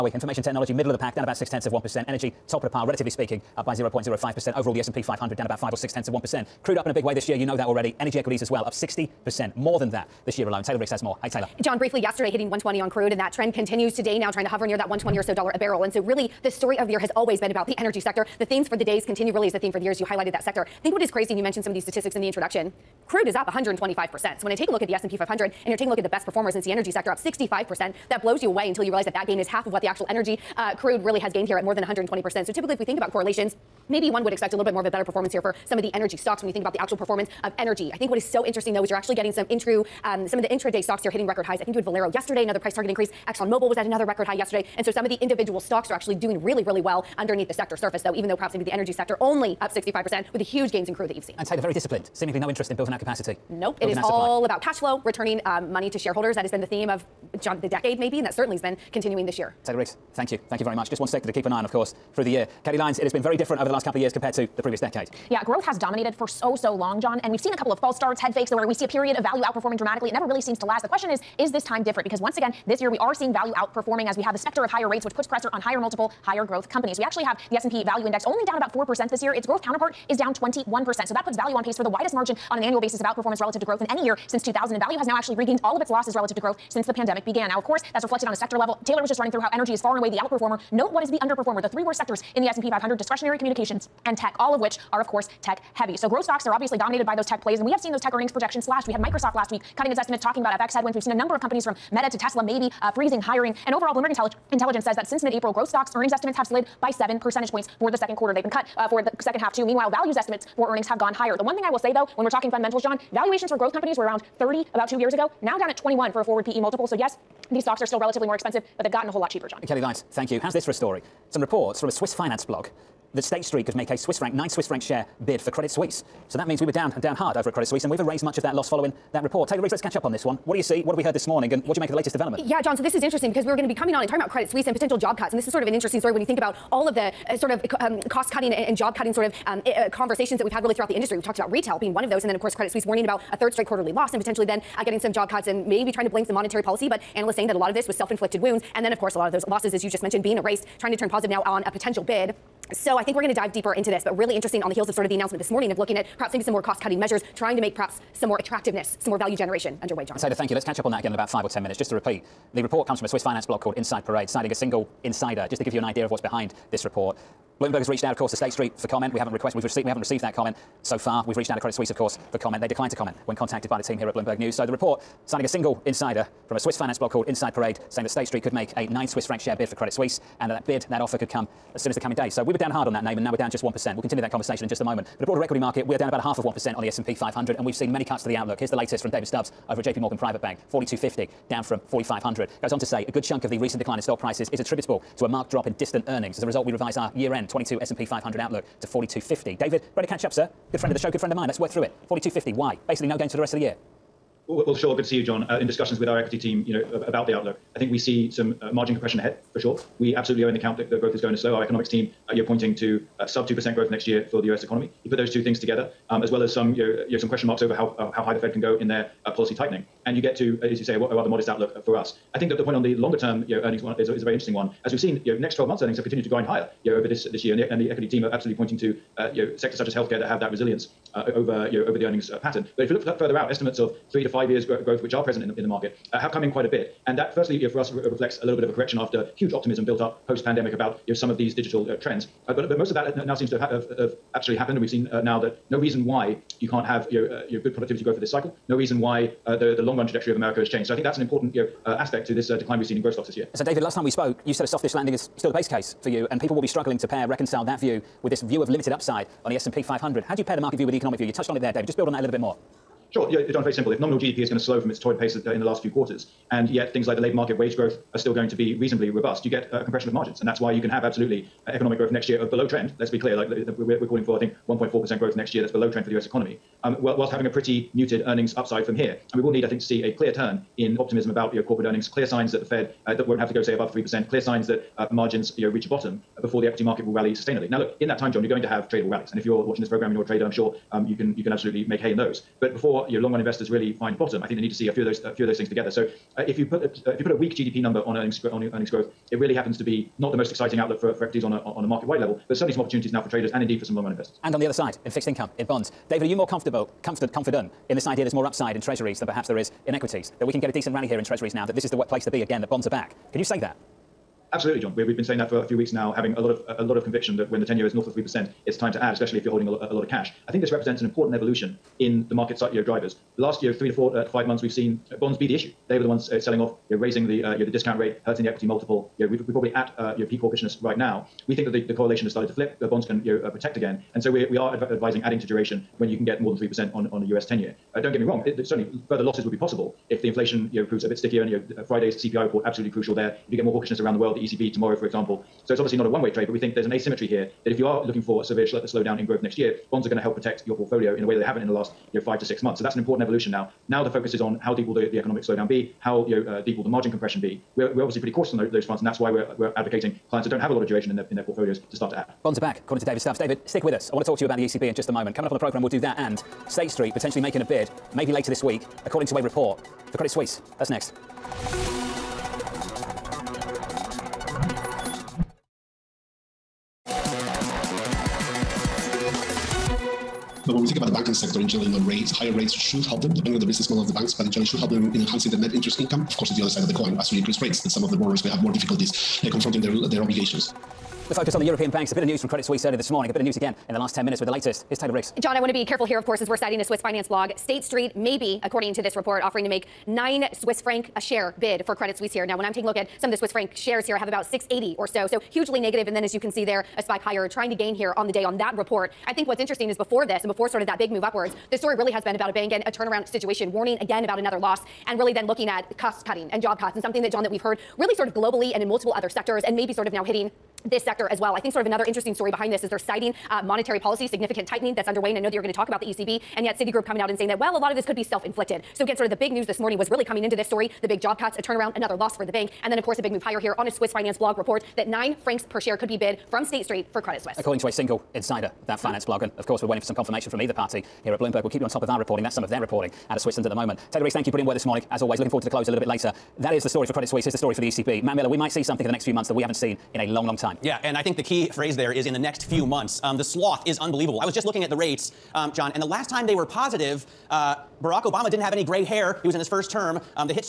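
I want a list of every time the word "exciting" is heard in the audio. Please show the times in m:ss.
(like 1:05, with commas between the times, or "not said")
5:00.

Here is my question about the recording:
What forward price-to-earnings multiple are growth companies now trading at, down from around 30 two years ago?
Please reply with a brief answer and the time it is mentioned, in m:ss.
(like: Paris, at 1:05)
21, at 1:55.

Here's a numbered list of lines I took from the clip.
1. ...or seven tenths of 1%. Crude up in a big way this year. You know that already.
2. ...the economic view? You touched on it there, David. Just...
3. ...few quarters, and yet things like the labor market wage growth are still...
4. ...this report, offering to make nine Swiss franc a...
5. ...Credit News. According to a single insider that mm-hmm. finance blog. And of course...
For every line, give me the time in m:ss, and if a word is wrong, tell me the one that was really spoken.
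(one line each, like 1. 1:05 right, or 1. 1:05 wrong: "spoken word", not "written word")
1. 0:05 wrong: "six", not "seven"
2. 4:20 right
3. 4:25 right
4. 6:39 right
5. 7:17 wrong: "Suisse", not "News".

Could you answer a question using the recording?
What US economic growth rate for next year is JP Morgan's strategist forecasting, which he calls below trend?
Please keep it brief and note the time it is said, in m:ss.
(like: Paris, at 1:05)
1.4%, at 4:34.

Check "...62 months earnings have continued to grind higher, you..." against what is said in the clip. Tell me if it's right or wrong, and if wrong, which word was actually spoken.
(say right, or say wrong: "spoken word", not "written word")
wrong: "12", not "62".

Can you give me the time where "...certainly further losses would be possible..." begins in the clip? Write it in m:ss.
5:38.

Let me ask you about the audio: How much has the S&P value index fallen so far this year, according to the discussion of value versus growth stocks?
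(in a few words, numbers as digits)
about 4%.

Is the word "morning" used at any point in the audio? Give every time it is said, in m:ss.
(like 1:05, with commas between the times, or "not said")
2:11, 2:35, 6:33, 7:09, 7:24.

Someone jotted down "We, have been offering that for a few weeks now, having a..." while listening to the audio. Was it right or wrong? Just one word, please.
wrong.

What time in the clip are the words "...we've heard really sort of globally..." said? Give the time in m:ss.
6:57.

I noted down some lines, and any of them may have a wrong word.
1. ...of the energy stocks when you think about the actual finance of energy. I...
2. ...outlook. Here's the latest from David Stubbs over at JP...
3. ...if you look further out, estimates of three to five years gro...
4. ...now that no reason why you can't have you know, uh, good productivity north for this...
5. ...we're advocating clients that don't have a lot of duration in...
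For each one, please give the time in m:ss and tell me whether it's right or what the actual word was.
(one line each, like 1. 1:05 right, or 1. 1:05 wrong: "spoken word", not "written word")
1. 0:35 wrong: "performance", not "finance"
2. 3:08 right
3. 3:52 right
4. 4:05 wrong: "growth", not "north"
5. 5:59 right.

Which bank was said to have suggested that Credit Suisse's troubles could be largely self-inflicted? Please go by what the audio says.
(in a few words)
Citigroup.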